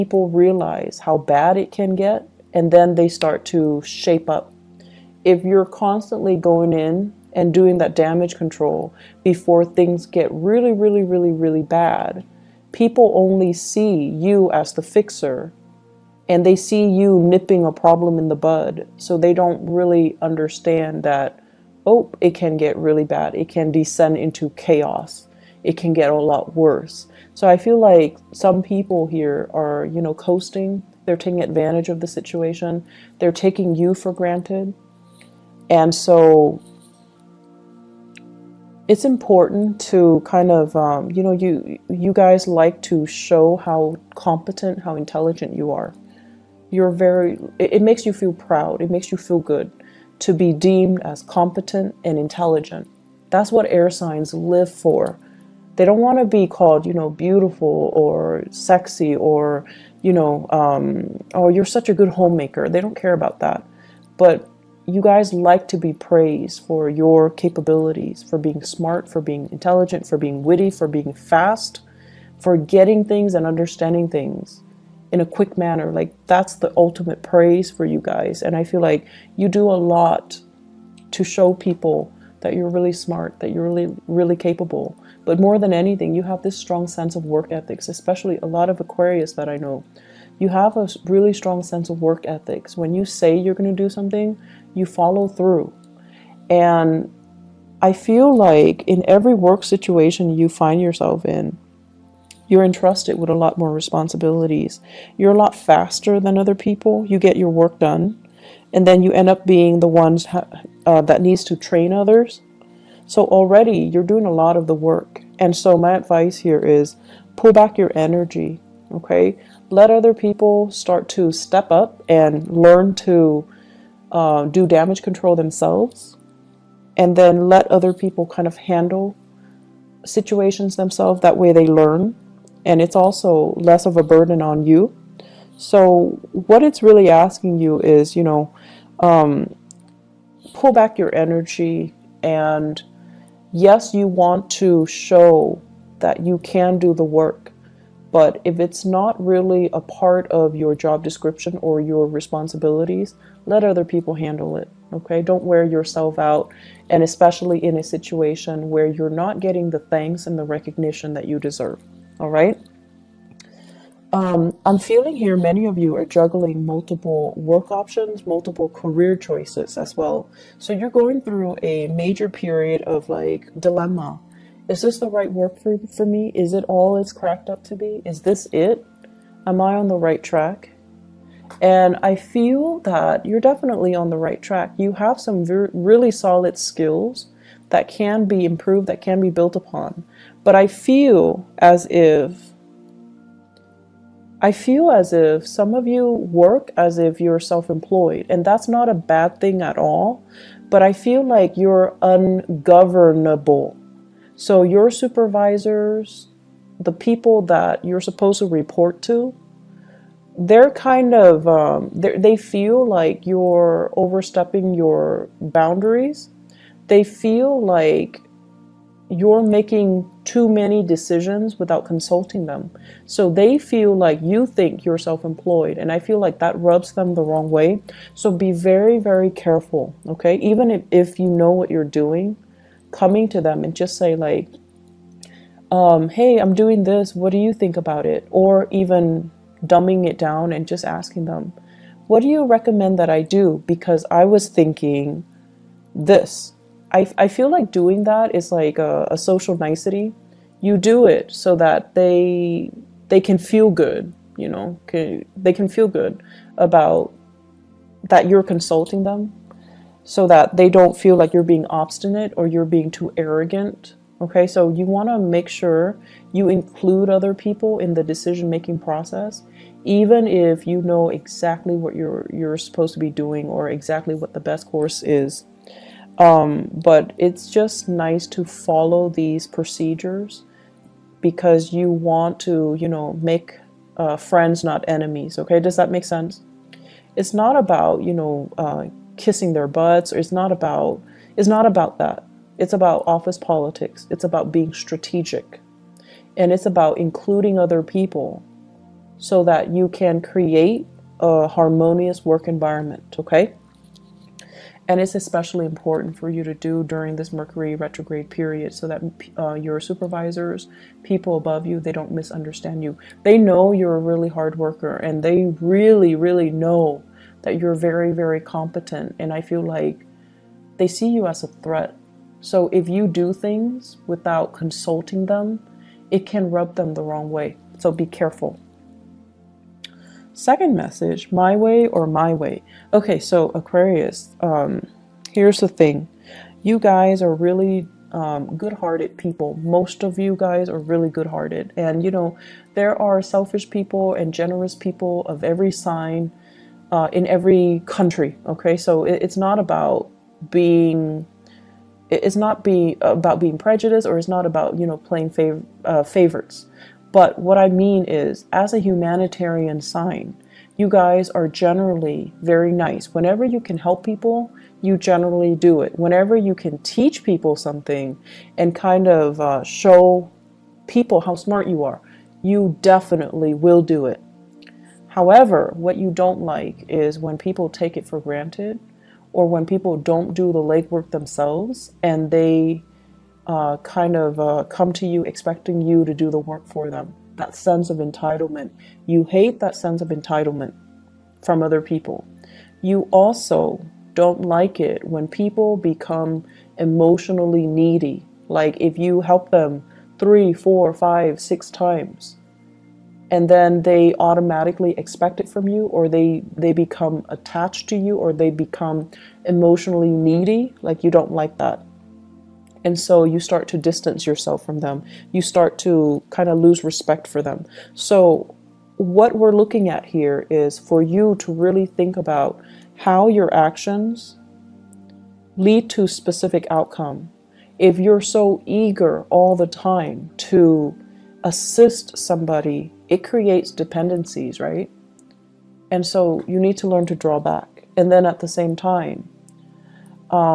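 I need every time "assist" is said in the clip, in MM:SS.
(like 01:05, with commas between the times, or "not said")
07:11.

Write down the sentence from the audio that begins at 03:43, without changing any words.
So they feel like you think you're self employed.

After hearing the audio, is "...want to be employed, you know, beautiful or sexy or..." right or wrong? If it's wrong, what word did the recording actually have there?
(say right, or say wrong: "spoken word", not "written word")
wrong: "called", not "employed".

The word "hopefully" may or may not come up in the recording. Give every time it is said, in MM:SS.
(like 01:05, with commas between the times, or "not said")
not said.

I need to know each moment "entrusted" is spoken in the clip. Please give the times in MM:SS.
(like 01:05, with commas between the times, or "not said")
01:42.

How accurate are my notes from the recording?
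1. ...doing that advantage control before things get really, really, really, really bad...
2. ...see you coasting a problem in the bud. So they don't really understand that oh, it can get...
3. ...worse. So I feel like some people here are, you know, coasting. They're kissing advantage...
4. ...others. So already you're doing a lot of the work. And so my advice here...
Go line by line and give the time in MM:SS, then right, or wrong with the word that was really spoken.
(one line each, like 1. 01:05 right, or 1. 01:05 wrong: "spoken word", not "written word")
1. 00:07 wrong: "damage", not "advantage"
2. 00:16 wrong: "nipping", not "coasting"
3. 00:26 wrong: "taking", not "kissing"
4. 01:51 right.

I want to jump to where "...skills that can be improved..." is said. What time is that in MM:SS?
03:06.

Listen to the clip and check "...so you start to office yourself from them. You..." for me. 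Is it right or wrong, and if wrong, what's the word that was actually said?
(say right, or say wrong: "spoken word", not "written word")
wrong: "distance", not "office".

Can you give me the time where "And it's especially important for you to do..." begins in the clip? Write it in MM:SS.
05:04.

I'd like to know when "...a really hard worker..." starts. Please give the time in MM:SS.
05:13.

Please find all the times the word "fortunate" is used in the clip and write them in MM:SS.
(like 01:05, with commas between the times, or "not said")
not said.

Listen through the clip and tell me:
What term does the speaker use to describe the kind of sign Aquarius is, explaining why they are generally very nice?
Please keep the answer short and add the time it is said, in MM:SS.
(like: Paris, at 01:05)
Humanitarian sign, at 05:58.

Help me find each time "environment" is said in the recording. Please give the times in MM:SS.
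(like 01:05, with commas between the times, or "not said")
05:02.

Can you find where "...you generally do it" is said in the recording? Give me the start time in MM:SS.
06:04.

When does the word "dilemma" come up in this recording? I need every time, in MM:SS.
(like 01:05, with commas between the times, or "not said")
02:53.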